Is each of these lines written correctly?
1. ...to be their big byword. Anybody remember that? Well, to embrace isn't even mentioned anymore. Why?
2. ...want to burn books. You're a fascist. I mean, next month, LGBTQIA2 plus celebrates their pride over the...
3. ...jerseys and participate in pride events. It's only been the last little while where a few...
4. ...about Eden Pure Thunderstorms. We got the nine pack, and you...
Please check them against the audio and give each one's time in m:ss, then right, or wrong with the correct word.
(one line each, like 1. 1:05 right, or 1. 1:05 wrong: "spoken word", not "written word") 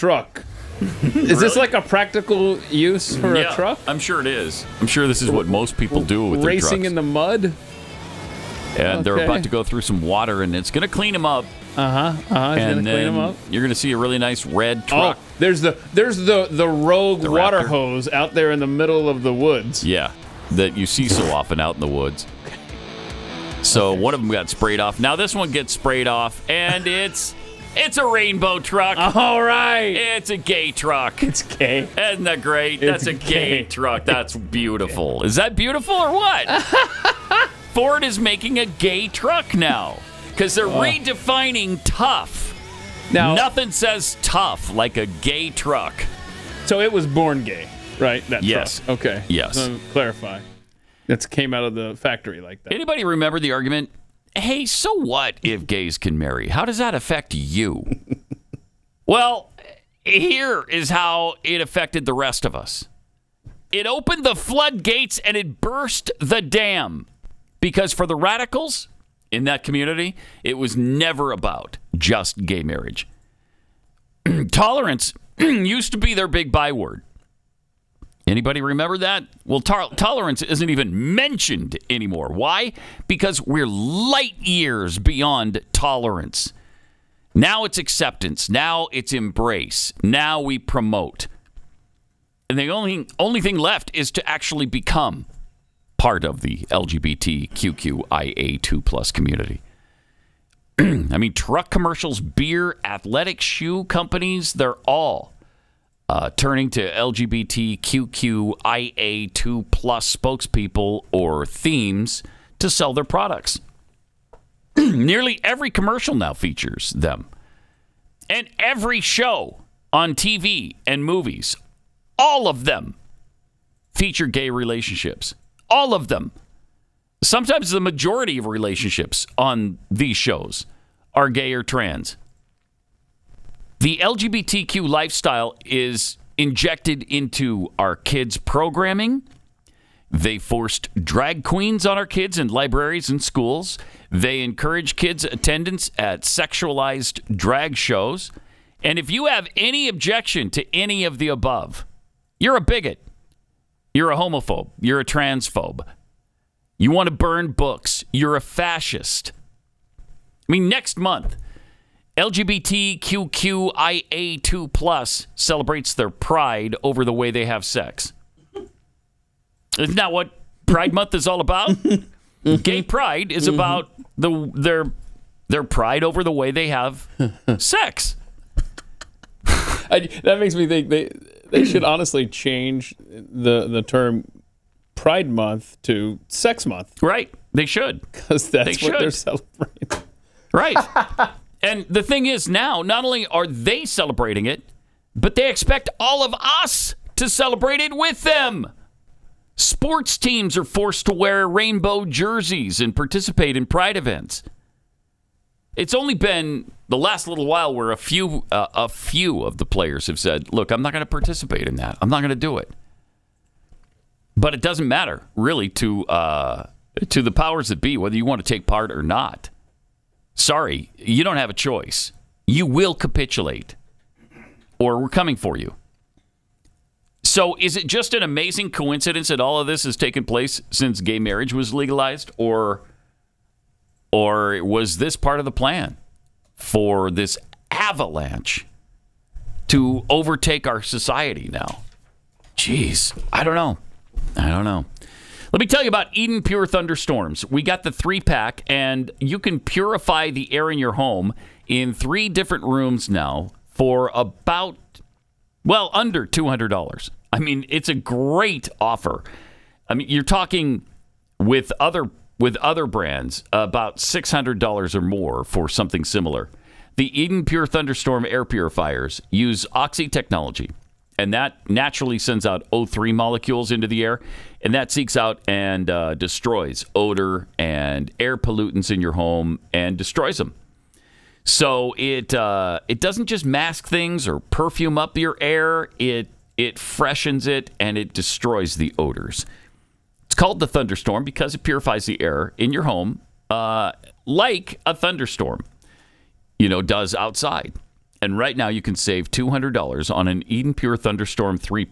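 1. 1:15 wrong: "tolerance", not "embrace"
2. 2:36 right
3. 3:22 right
4. 4:05 wrong: "three", not "nine".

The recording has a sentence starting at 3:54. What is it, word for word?
Or was this part of the plan for this avalanche to overtake our society now?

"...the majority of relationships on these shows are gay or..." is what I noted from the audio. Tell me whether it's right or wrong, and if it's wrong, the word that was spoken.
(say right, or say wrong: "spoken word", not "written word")
right.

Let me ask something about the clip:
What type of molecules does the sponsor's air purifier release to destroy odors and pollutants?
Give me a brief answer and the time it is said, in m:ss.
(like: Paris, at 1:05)
O3 molecules, at 4:32.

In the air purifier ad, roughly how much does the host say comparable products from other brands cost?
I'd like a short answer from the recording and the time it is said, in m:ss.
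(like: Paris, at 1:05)
$600, at 4:23.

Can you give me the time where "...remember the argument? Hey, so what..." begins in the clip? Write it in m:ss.
0:53.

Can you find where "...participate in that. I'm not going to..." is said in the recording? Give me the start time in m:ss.
3:31.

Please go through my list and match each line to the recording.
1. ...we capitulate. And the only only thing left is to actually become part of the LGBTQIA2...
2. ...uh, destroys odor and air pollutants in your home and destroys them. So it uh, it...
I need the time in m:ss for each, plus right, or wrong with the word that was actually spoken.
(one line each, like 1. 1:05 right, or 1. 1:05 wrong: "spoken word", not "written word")
1. 1:30 wrong: "promote", not "capitulate"
2. 4:35 right.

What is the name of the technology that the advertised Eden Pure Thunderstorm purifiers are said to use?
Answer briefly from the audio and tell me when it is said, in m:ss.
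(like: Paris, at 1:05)
Oxy technology, at 4:29.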